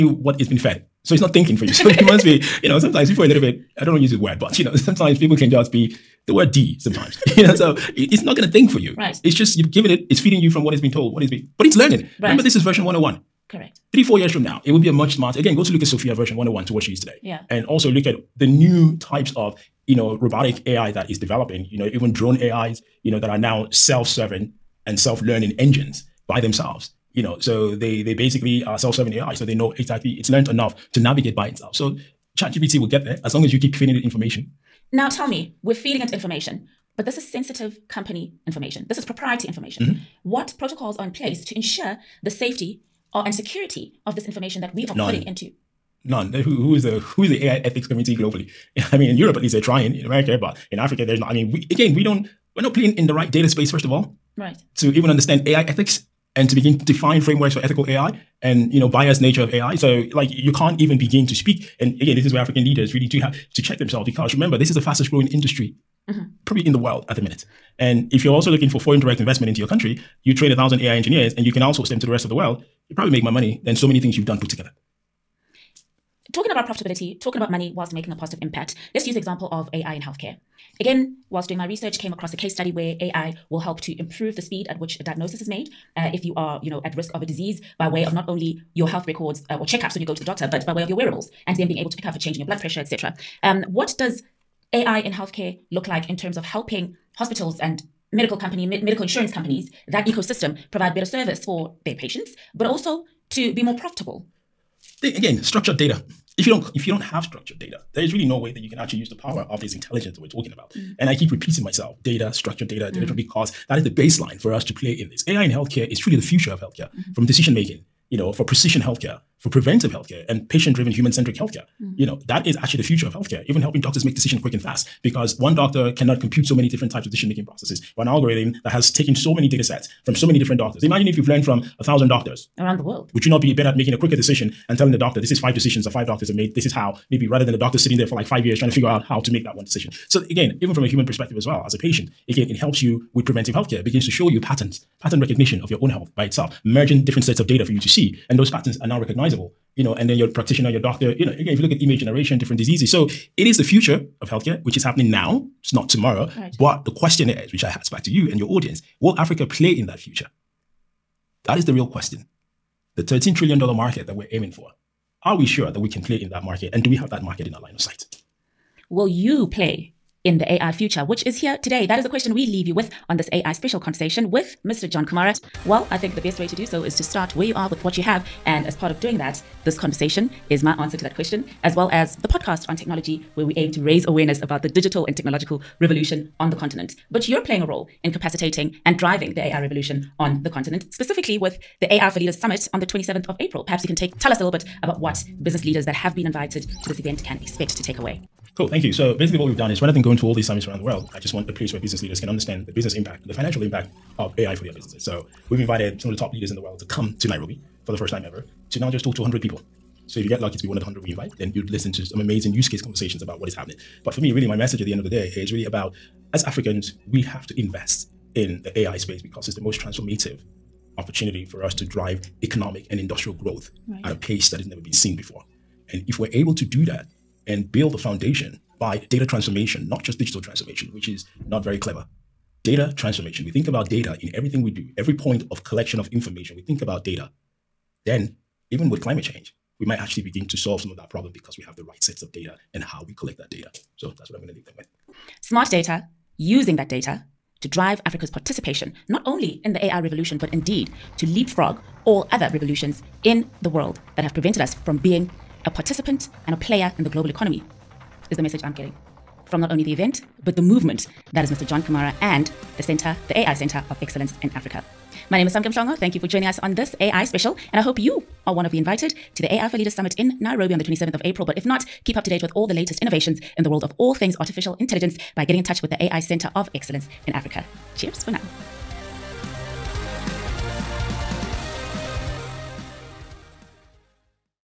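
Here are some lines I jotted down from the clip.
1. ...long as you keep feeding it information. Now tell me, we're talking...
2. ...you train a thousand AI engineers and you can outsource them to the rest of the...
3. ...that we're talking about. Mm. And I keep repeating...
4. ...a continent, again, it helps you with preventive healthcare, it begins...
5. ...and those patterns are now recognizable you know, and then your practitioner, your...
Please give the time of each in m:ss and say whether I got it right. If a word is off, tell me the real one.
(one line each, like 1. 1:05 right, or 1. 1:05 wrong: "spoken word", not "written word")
1. 0:33 wrong: "feeding", not "talking"
2. 1:10 right
3. 1:50 right
4. 2:21 wrong: "patient", not "continent"
5. 2:28 right.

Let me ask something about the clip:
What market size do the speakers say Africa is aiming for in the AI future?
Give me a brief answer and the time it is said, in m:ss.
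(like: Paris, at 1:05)
$13 trillion, at 2:43.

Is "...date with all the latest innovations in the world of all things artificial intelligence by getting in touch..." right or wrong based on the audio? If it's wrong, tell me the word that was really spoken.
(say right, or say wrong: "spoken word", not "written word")
right.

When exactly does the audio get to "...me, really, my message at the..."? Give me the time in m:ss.
3:34.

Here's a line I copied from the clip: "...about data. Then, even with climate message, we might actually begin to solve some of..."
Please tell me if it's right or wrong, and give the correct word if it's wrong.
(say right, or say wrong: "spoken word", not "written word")
wrong: "change", not "message".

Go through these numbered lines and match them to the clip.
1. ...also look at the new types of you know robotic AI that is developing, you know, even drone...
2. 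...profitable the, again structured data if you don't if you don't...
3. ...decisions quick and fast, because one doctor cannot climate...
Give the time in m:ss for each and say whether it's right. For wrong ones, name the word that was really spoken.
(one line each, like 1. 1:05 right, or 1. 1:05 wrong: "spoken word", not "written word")
1. 0:17 right
2. 1:43 right
3. 2:04 wrong: "compute", not "climate".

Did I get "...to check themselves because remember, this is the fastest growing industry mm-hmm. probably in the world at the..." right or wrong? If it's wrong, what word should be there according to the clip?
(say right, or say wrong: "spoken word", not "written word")
right.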